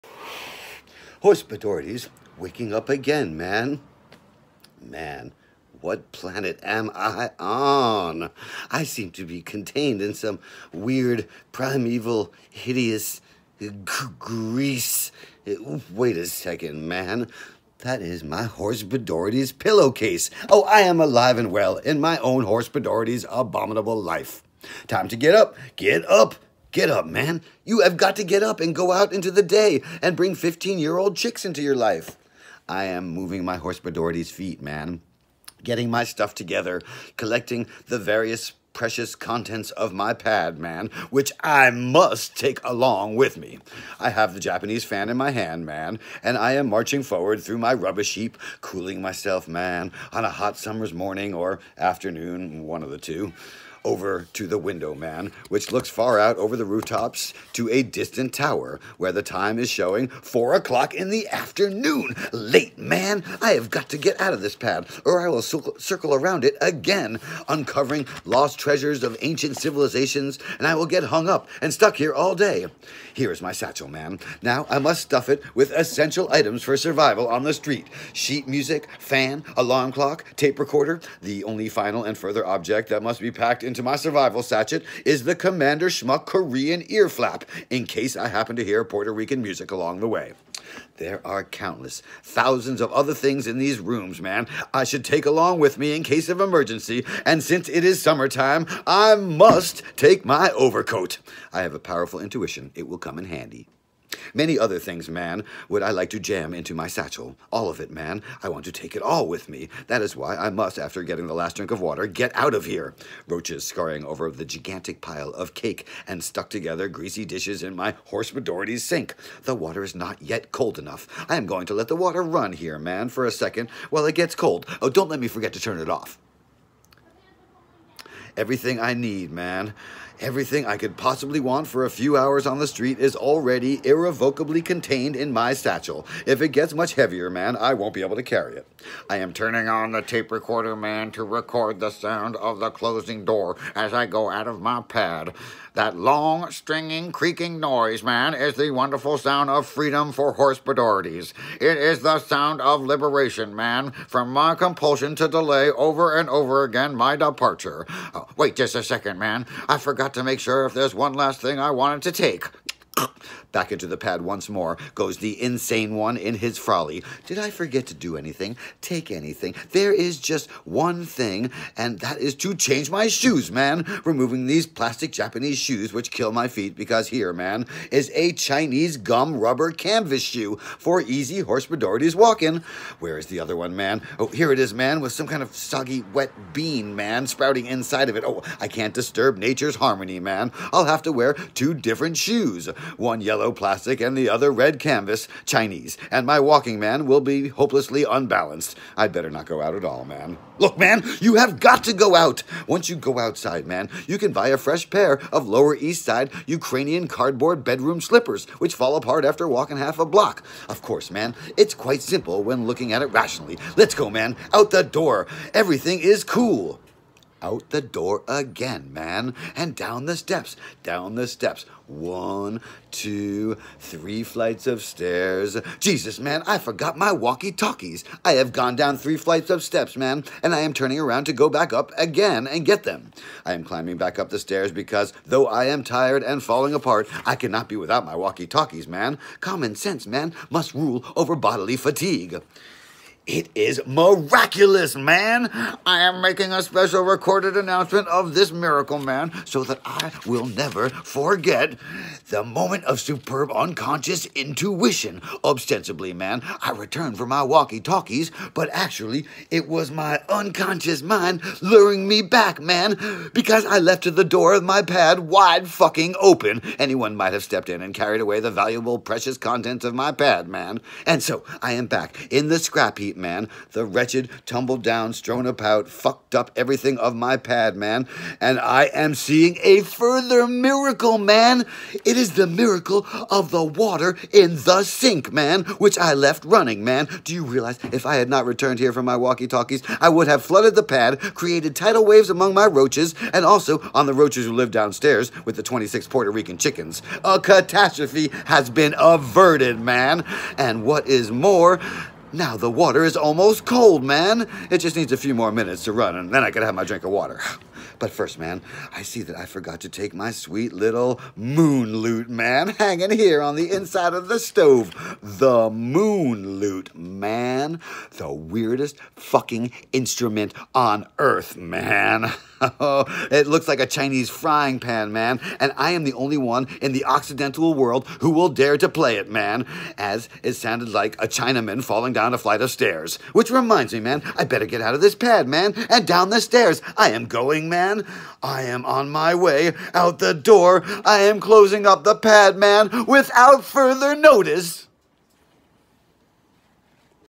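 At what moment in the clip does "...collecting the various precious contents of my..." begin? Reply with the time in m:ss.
0:37.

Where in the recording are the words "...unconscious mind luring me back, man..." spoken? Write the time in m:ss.
4:20.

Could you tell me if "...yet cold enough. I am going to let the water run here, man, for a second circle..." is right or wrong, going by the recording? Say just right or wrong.
wrong.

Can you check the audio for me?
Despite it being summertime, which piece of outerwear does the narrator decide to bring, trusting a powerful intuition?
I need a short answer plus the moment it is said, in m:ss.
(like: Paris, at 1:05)
Overcoat, at 1:40.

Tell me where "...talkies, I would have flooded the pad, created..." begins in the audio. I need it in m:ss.
4:49.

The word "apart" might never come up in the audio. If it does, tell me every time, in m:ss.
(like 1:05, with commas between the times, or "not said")
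3:28, 3:56.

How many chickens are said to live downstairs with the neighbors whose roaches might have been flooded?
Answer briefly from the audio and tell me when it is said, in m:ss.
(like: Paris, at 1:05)
26, at 4:55.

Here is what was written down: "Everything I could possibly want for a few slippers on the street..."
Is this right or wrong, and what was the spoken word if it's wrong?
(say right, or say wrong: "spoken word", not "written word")
wrong: "hours", not "slippers".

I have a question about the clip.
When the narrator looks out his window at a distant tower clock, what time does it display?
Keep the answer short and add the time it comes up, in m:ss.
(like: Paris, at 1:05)
4 o'clock in the afternoon, at 1:00.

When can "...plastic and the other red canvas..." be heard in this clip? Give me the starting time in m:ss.
3:13.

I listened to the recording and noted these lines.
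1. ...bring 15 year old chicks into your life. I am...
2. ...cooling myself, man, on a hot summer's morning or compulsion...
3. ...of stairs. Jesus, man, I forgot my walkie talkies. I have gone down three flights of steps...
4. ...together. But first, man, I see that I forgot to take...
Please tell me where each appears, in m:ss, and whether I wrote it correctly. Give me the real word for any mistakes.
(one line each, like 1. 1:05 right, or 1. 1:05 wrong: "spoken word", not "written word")
1. 0:30 right
2. 0:48 wrong: "afternoon", not "compulsion"
3. 3:44 right
4. 5:07 wrong: "water", not "together".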